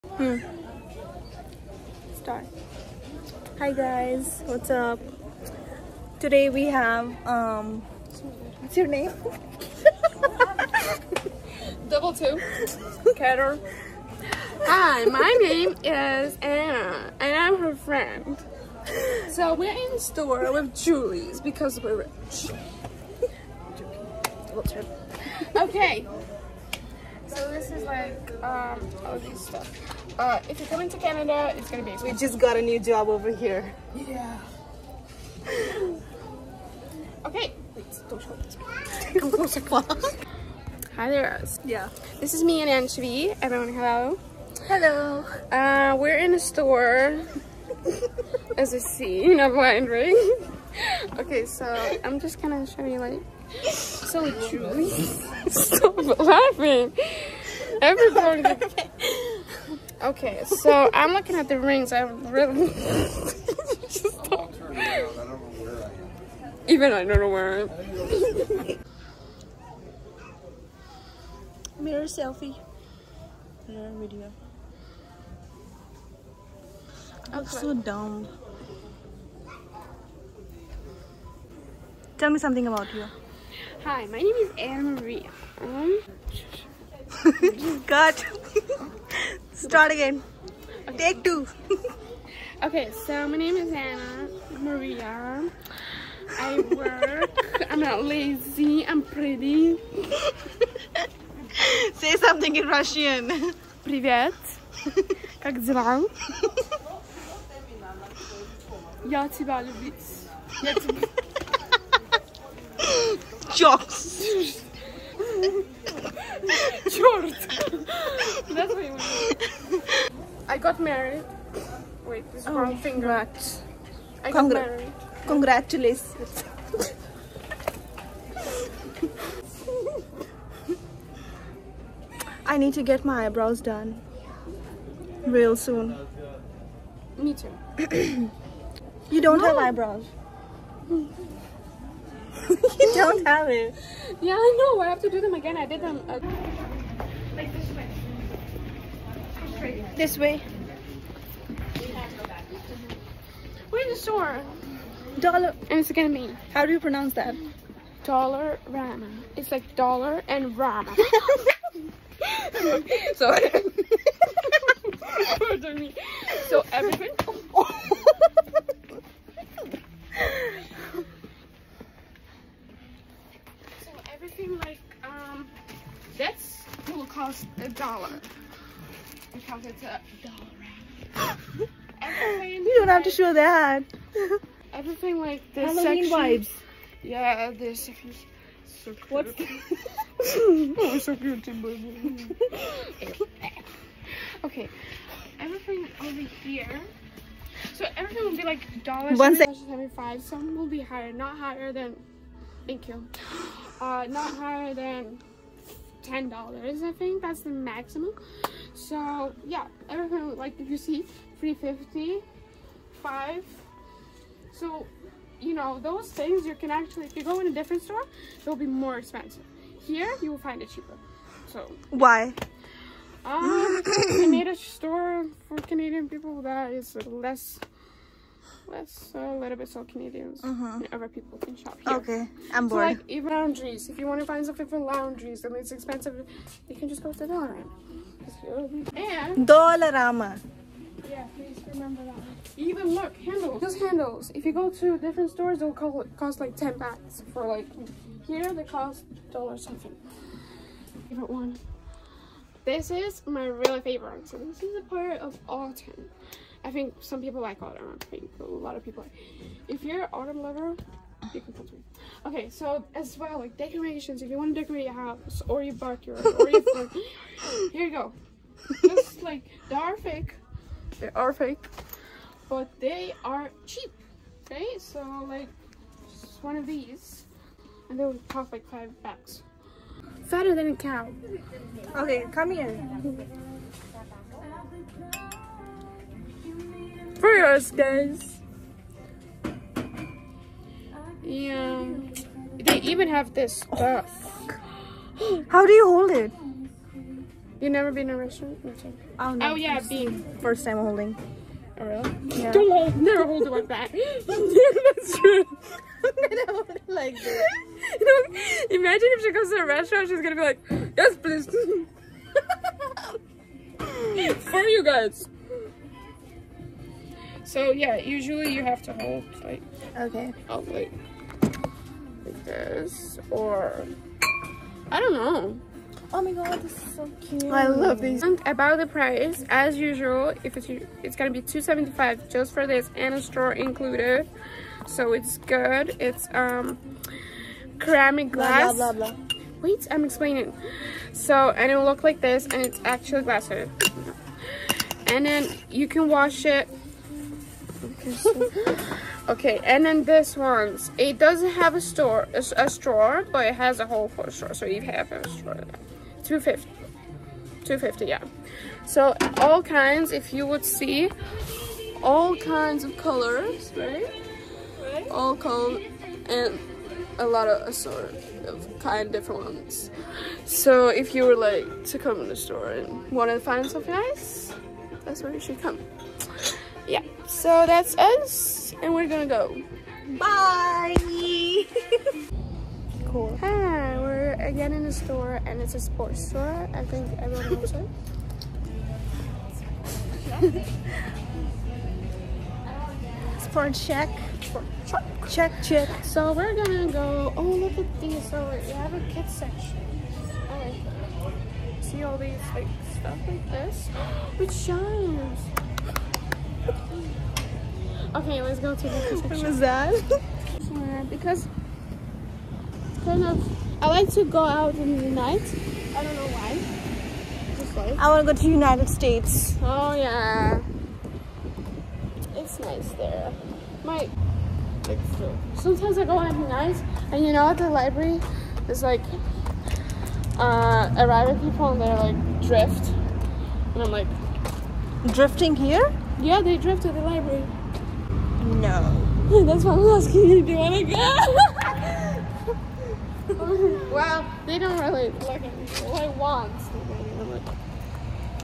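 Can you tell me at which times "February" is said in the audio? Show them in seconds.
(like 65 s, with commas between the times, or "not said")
not said.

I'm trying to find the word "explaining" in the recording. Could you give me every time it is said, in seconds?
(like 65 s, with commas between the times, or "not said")
340 s.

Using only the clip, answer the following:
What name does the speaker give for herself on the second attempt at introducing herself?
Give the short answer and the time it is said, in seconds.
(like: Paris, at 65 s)
Anna Maria, at 93 s.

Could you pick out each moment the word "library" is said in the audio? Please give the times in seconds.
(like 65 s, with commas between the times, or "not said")
427 s, 437 s.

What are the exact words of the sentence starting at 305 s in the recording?
I'm gonna hold it like this.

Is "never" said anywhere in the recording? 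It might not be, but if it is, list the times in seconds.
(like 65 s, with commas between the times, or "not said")
297 s, 302 s.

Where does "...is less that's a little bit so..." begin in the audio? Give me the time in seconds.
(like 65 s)
226 s.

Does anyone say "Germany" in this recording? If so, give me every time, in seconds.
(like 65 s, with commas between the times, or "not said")
not said.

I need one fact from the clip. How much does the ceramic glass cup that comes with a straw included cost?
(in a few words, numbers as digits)
2.75.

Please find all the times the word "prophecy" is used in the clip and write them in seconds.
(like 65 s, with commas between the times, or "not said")
not said.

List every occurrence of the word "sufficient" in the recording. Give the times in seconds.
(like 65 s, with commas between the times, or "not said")
not said.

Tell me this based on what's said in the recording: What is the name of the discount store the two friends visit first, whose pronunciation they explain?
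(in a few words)
Dollarama.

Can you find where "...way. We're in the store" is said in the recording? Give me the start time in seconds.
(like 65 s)
150 s.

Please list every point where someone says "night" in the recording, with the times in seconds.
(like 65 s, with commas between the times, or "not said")
415 s, 426 s.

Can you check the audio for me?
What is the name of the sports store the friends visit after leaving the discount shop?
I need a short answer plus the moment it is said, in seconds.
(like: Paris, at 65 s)
Sports Chek, at 393 s.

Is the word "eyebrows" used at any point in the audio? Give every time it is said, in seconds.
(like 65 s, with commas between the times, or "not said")
133 s, 139 s.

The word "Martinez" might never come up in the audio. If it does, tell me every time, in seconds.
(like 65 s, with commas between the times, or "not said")
not said.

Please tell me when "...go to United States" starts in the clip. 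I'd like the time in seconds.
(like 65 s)
418 s.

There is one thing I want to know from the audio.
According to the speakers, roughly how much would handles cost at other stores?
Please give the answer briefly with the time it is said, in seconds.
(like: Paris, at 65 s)
10 bucks, at 246 s.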